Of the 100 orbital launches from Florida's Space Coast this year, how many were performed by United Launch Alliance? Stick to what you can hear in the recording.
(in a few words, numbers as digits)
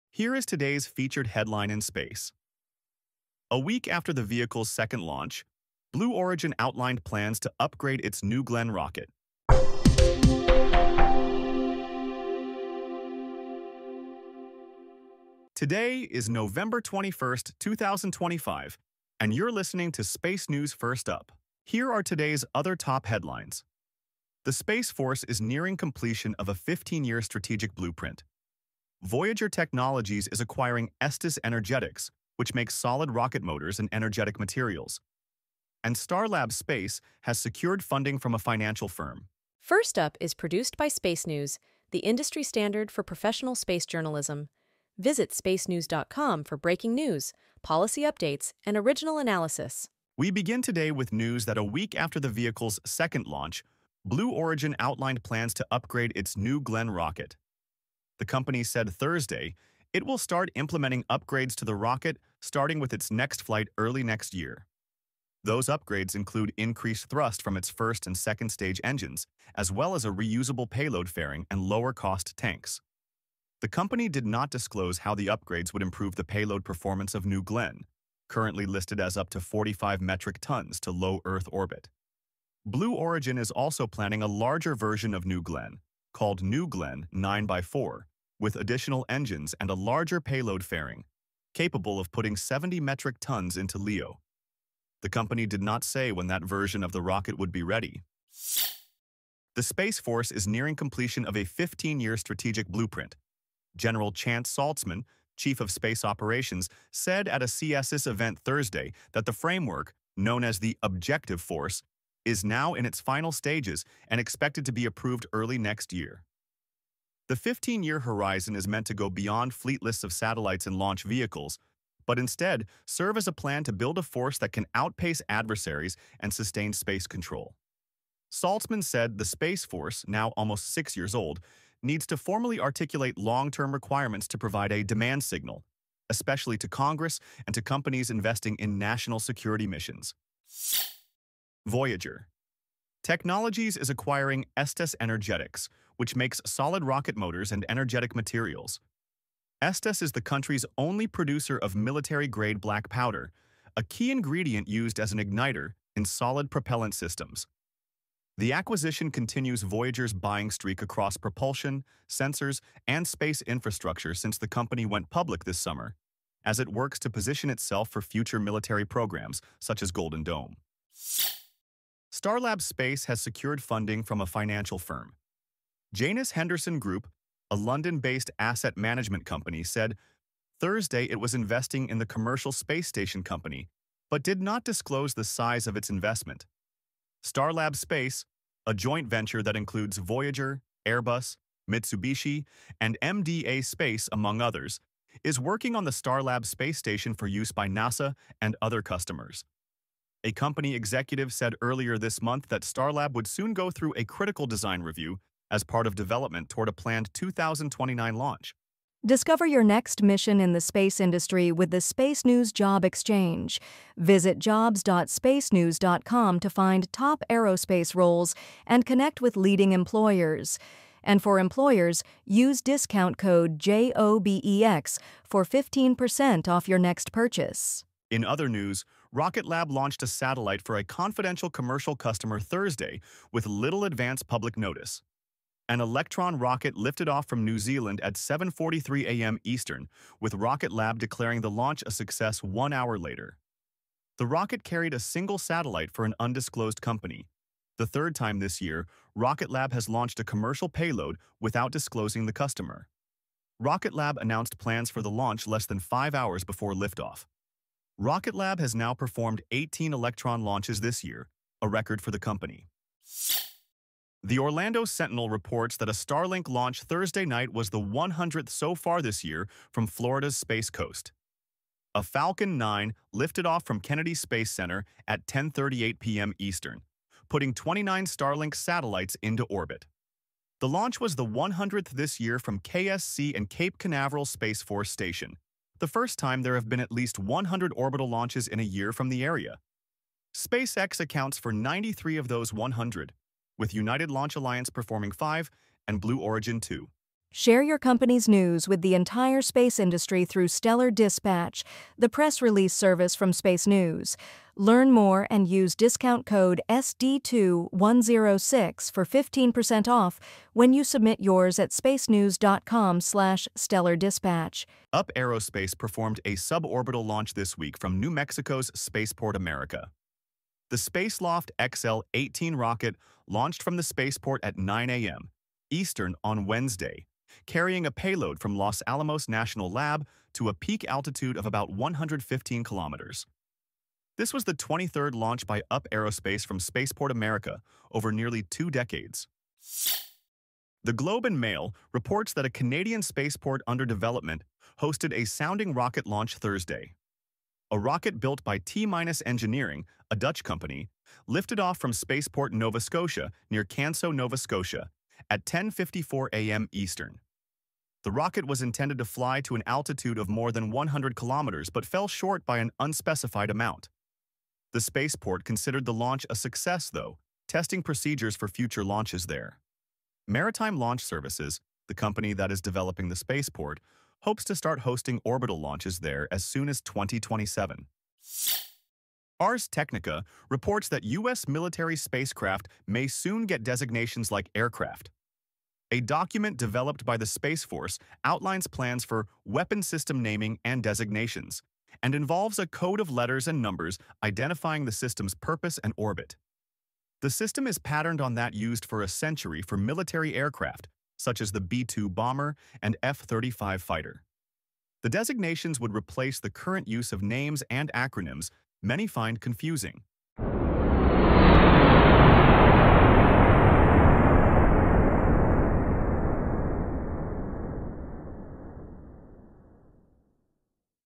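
5.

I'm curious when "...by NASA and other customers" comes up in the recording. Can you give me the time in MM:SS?
03:17.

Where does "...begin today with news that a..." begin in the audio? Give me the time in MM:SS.
00:50.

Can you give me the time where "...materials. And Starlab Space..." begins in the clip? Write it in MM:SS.
00:34.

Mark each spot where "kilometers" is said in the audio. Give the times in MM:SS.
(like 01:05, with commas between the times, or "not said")
05:32, 06:01.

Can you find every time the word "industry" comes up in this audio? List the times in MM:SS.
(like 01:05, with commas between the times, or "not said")
00:41, 03:30, 04:59.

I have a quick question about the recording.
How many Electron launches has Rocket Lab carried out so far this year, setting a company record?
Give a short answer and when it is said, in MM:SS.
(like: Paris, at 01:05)
18, at 04:19.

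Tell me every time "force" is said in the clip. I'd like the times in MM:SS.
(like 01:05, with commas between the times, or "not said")
00:24, 01:39, 01:51, 02:04, 02:09, 04:44, 06:27.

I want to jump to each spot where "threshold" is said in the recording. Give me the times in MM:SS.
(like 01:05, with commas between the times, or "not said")
not said.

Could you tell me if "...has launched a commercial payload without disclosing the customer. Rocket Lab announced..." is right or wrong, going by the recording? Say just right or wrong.
right.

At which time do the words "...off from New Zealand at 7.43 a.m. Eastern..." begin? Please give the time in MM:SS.
03:57.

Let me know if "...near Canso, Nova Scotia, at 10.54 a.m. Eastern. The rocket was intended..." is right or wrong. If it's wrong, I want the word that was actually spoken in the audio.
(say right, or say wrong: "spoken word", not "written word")
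right.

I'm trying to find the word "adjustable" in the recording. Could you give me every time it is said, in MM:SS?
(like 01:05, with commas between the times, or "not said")
not said.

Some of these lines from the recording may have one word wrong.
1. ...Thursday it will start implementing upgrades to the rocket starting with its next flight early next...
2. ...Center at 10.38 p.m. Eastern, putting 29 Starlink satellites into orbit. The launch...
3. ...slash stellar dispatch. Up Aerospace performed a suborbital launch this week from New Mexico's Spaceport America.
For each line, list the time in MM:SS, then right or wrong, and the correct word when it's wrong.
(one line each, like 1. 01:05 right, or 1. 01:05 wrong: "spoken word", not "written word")
1. 00:58 right
2. 04:34 right
3. 05:13 right.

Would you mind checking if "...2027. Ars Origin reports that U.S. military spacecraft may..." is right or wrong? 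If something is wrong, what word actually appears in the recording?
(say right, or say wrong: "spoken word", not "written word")
wrong: "Technica", not "Origin".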